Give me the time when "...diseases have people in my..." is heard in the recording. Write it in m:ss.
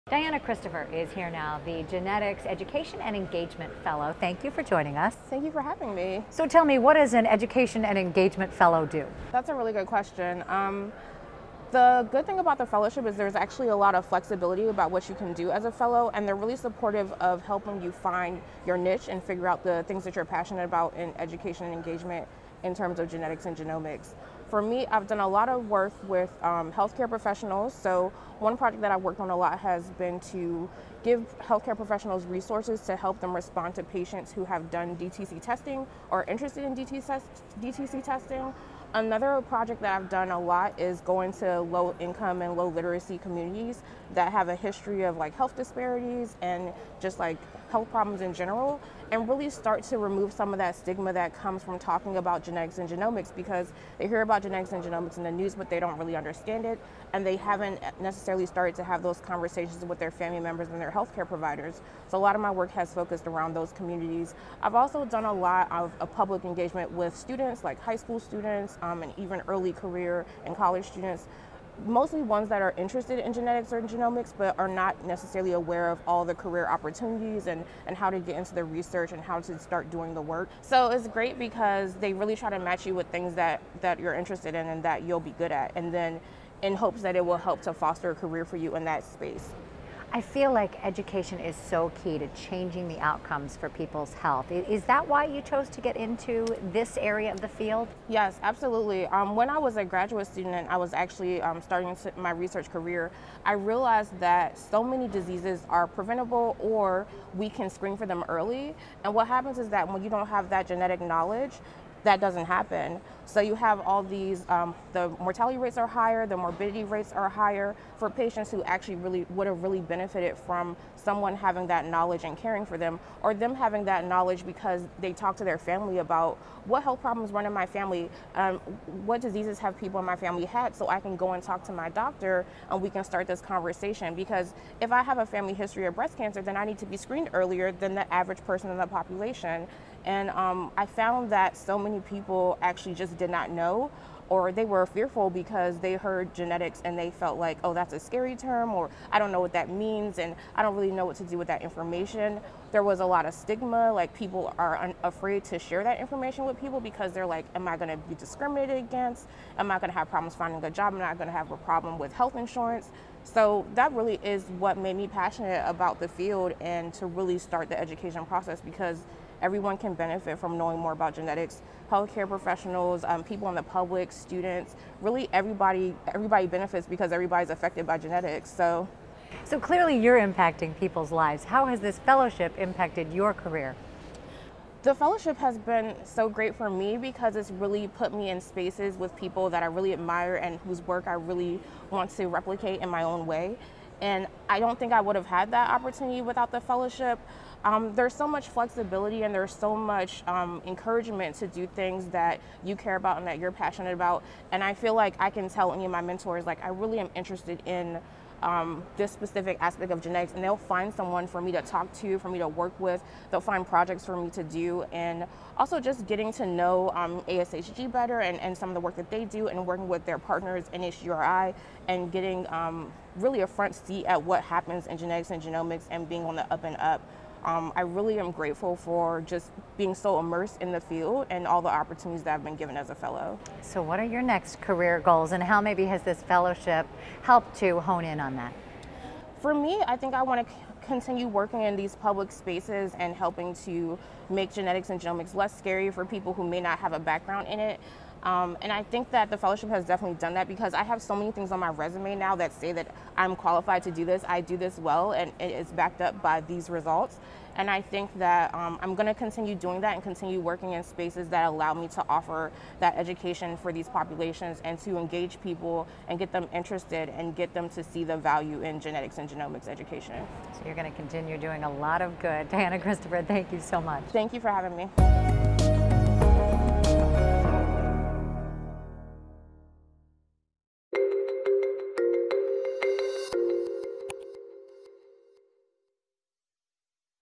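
2:09.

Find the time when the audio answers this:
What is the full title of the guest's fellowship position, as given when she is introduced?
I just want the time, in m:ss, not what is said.
0:01.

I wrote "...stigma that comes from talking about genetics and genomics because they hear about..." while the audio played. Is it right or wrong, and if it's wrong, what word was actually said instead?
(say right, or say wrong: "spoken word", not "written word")
right.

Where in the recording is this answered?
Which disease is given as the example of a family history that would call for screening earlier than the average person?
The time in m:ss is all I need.
2:15.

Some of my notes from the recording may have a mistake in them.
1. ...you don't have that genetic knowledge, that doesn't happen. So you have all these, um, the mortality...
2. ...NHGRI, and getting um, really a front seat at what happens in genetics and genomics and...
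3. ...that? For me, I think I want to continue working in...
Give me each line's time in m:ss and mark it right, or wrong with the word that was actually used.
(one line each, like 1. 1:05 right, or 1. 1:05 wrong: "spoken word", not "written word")
1. 1:50 right
2. 3:40 right
3. 3:58 right.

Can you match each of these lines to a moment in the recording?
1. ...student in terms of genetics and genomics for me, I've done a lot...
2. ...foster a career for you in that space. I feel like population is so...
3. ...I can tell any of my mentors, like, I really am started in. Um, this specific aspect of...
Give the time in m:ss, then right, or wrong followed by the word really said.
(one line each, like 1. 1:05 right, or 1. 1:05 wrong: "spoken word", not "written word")
1. 0:21 wrong: "engagement", not "student"
2. 1:27 wrong: "education", not "population"
3. 3:25 wrong: "interested", not "started".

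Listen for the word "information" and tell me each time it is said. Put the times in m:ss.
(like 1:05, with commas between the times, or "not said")
2:31, 2:35.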